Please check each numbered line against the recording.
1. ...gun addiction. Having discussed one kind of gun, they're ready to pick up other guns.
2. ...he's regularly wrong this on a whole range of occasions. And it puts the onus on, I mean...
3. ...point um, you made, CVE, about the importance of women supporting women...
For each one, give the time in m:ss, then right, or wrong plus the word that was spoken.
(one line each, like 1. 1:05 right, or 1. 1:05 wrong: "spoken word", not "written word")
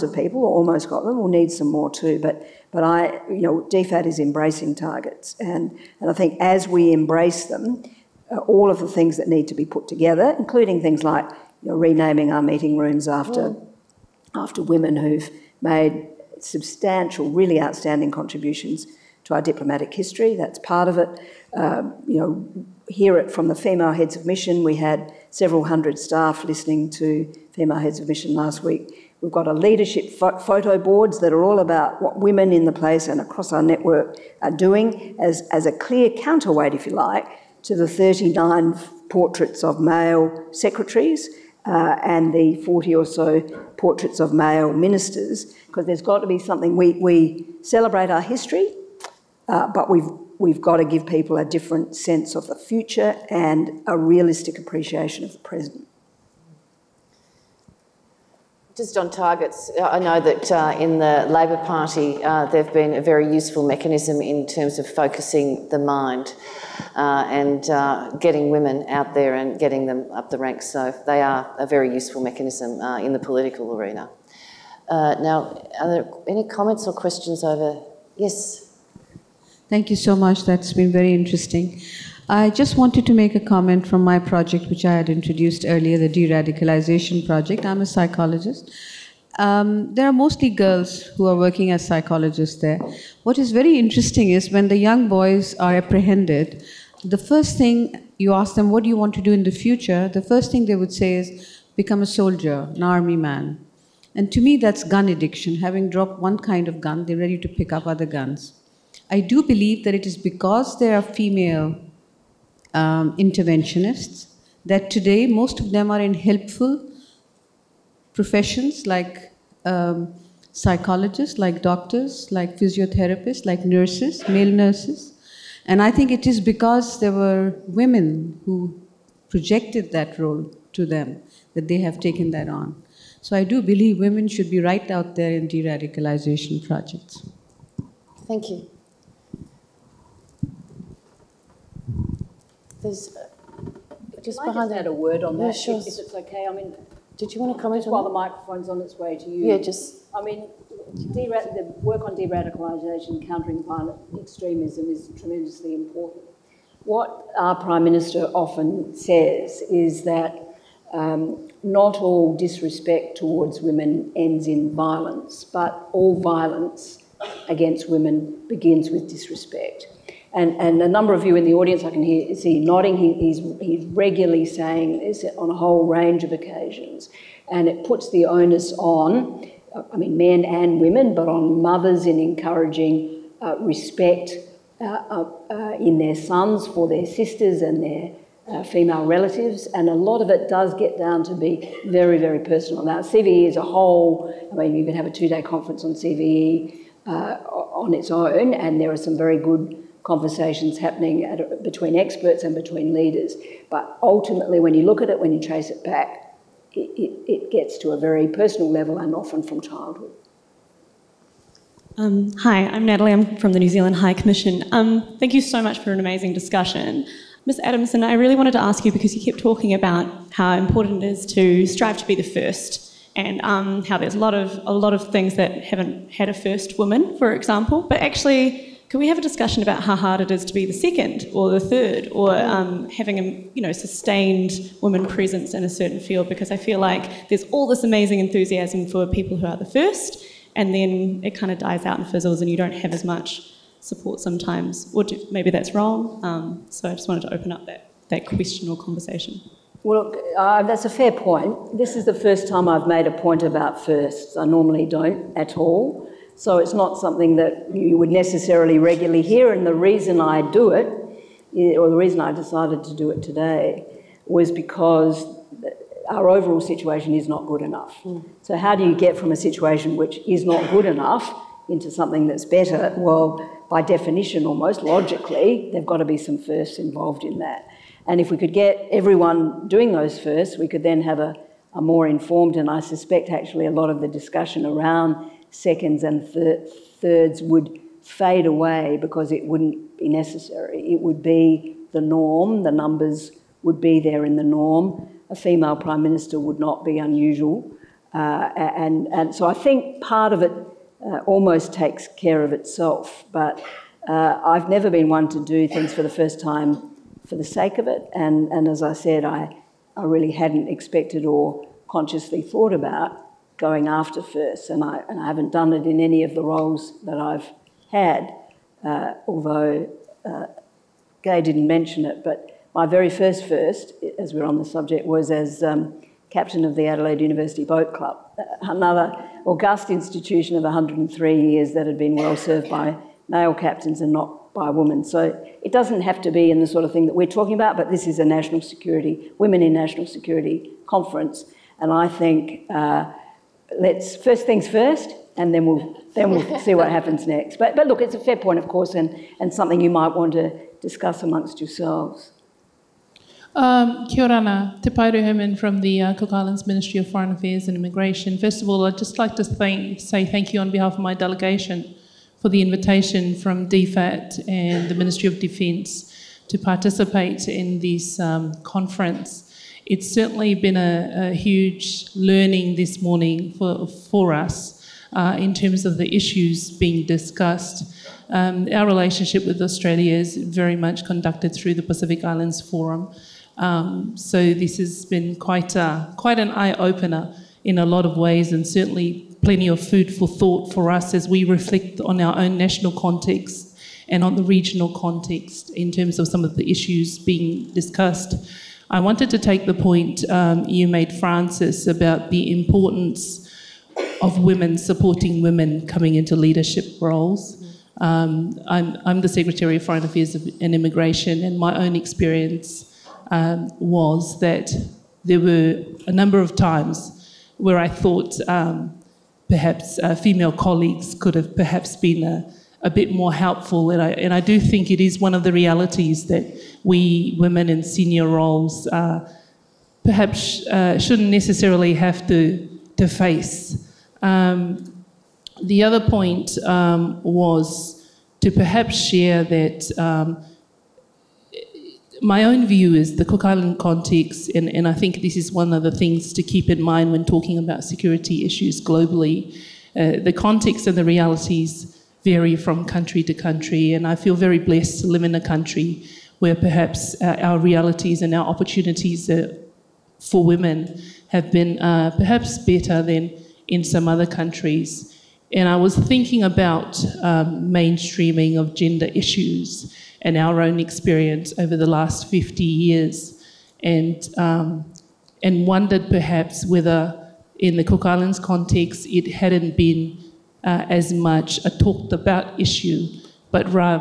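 1. 1:44 wrong: "dropped", not "discussed"
2. 2:53 wrong: "saying", not "wrong"
3. 6:39 wrong: "Frances", not "CVE".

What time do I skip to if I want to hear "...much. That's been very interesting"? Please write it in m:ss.
1:20.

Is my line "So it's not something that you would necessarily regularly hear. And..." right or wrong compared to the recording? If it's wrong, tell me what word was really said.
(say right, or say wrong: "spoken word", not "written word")
right.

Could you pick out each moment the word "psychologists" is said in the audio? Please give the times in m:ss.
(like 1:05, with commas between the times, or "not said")
1:27, 1:31, 2:00.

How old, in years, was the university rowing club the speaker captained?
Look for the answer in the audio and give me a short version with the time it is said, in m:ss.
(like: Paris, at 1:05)
103, at 5:30.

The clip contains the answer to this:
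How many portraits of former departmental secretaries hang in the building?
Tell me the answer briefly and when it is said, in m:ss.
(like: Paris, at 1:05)
39, at 0:37.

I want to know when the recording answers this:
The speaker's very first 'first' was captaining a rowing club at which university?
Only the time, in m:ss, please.
5:26.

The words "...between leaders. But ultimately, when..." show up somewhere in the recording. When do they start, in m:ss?
3:22.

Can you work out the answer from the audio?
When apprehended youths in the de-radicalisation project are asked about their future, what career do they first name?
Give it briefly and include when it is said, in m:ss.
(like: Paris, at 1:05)
Soldier, at 1:41.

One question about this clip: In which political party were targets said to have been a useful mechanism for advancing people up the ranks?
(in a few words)
Labor Party.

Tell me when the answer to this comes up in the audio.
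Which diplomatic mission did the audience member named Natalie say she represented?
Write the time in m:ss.
3:33.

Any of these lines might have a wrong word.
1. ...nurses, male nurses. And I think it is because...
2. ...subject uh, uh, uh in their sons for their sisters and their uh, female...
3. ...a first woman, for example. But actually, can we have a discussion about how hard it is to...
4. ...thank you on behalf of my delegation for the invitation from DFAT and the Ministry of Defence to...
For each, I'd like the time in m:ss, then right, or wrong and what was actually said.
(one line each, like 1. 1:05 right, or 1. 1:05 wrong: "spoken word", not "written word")
1. 2:03 right
2. 3:03 wrong: "respect", not "subject"
3. 3:46 right
4. 6:00 right.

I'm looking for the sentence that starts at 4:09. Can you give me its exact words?
Well, look, uh, that's a fair point.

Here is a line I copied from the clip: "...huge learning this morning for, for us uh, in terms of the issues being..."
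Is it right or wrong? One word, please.
right.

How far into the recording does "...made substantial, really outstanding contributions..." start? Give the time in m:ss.
0:15.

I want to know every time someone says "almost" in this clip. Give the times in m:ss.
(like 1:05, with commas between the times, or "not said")
0:00, 4:34, 5:01.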